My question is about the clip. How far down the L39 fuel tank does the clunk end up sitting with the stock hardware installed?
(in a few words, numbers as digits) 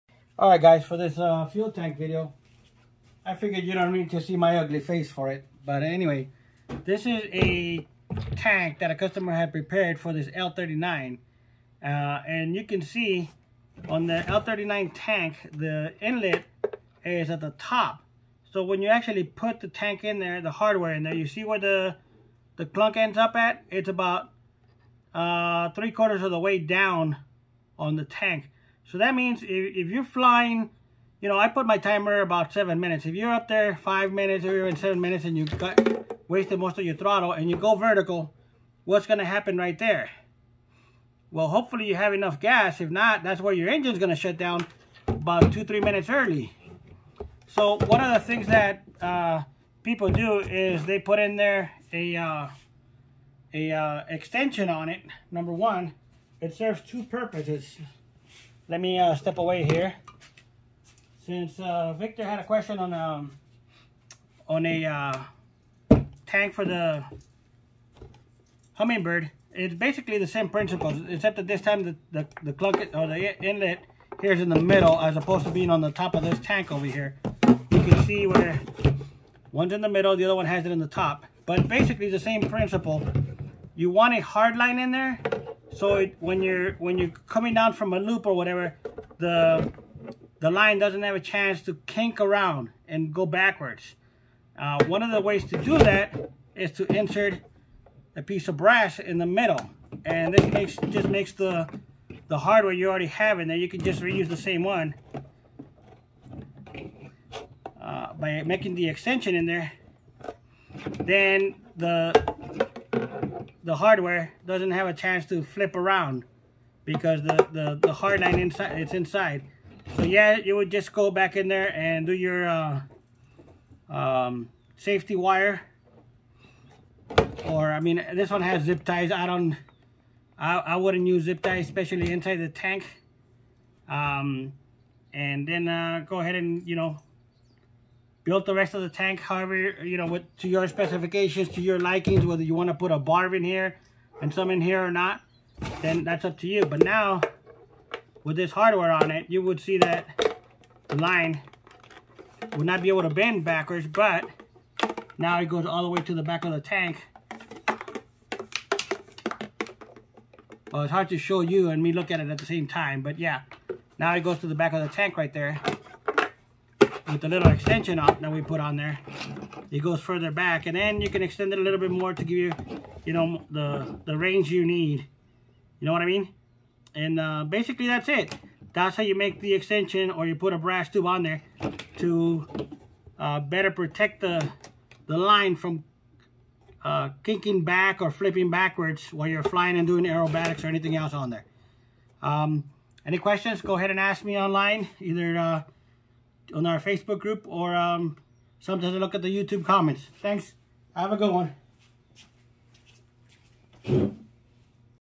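three quarters.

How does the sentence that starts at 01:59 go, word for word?
So yeah, you would just go back in there and do your uh, um, safety wire.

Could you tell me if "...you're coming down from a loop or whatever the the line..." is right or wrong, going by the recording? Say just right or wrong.
right.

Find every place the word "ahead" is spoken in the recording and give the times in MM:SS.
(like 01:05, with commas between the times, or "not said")
02:16, 03:13.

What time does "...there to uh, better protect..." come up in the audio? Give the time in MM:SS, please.
03:01.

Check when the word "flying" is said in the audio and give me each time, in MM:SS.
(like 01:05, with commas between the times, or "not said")
00:30, 03:09.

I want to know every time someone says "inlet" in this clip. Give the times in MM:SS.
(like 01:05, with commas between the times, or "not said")
00:16, 01:13.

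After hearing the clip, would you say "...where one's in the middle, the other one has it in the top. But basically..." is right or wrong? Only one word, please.
right.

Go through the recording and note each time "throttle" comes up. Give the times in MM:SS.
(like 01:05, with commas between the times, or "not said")
00:36.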